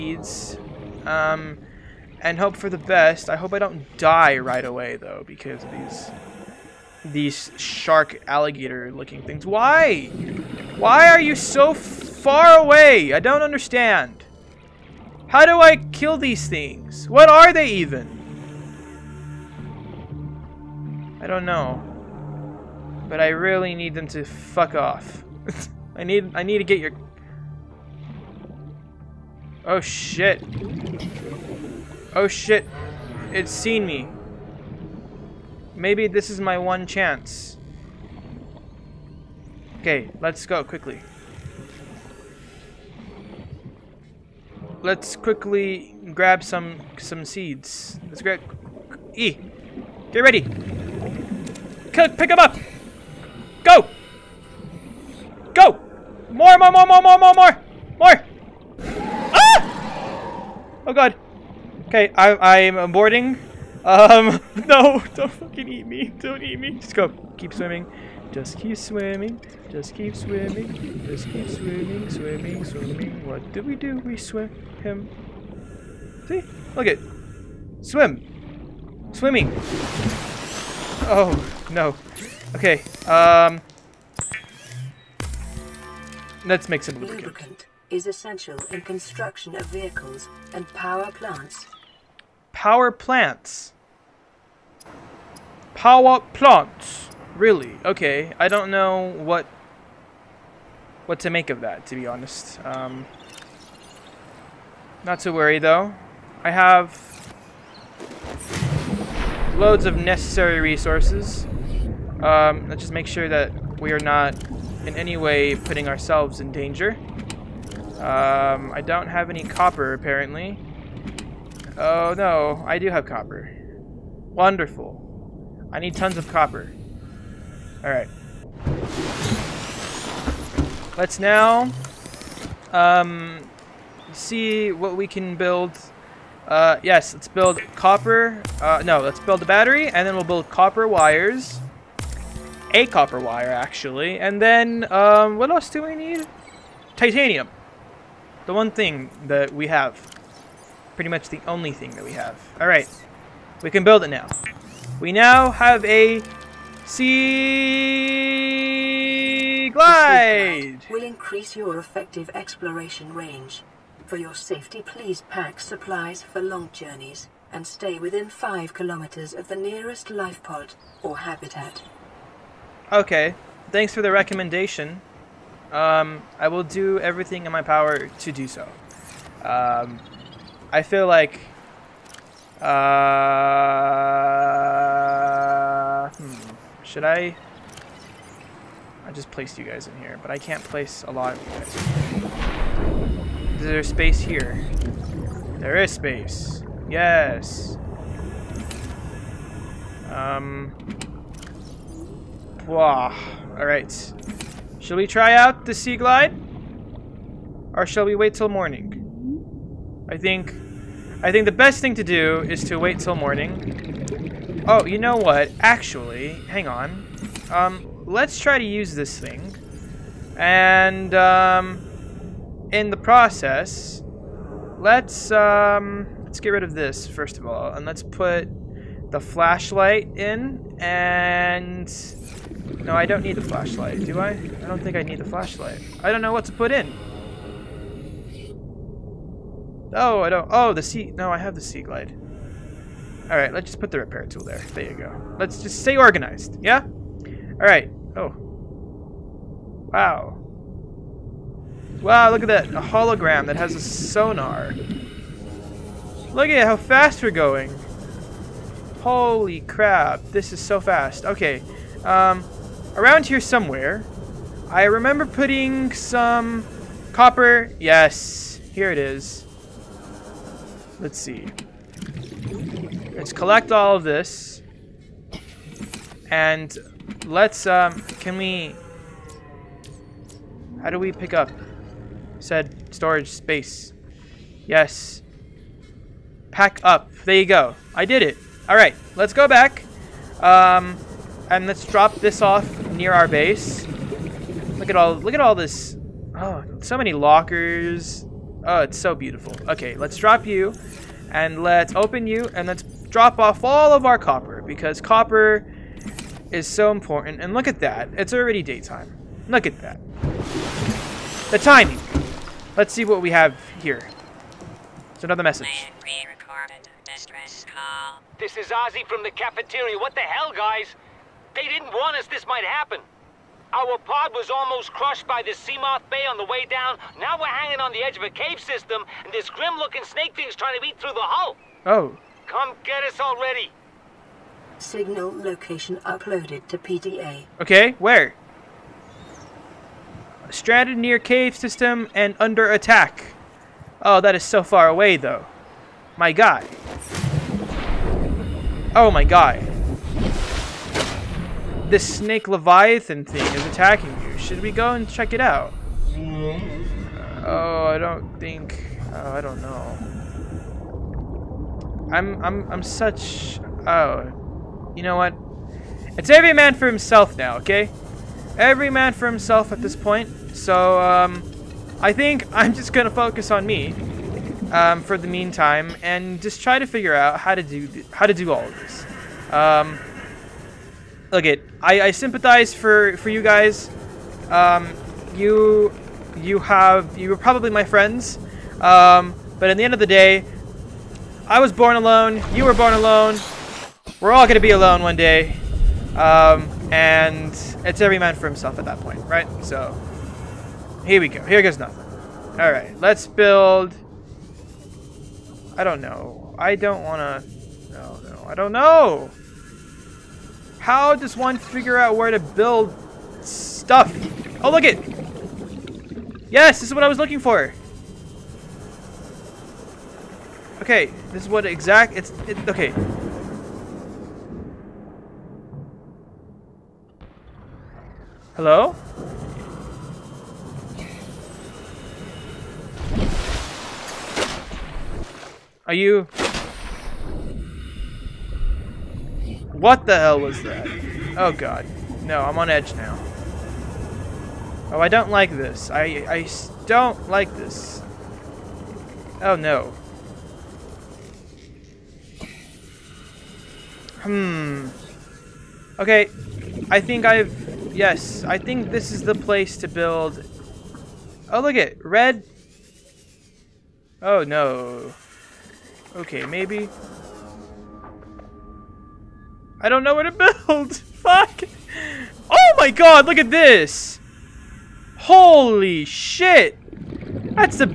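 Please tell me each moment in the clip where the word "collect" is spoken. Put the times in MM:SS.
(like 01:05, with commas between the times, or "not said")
04:33.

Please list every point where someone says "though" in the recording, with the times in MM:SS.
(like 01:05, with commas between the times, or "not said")
00:04, 01:45, 05:45.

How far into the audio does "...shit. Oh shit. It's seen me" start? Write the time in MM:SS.
00:29.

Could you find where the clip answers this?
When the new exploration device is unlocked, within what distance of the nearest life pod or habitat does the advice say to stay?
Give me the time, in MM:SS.
02:48.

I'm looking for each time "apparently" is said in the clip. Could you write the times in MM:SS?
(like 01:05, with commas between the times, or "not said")
01:59.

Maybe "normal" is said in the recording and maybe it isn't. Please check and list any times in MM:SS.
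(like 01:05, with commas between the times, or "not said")
not said.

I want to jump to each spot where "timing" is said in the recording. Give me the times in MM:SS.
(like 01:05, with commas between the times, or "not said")
05:11.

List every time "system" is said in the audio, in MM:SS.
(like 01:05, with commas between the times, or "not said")
05:28, 05:41.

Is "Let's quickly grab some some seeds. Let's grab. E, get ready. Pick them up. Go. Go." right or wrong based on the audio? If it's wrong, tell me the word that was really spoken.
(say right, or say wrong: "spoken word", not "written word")
right.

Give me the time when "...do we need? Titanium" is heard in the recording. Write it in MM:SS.
02:25.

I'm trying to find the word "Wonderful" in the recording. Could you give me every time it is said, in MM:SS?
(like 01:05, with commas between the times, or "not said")
02:04.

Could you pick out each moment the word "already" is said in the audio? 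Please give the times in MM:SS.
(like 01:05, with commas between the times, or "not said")
05:08, 05:33.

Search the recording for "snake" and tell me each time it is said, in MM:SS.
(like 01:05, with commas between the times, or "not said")
05:30, 05:52.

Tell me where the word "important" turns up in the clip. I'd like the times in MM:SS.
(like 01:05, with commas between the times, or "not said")
05:06.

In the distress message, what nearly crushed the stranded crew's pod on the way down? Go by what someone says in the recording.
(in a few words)
Seamoth Bay.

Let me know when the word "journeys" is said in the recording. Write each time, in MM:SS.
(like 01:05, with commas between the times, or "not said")
02:46.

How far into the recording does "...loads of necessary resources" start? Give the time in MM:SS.
01:49.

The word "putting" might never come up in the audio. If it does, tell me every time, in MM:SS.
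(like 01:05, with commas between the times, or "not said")
01:55, 04:25.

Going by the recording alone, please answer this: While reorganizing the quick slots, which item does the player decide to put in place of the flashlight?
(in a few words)
Repair tool.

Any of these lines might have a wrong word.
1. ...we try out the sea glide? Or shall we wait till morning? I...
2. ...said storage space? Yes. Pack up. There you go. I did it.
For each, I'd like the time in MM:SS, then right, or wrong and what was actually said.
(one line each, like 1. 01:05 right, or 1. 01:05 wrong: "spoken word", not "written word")
1. 03:24 right
2. 04:42 right.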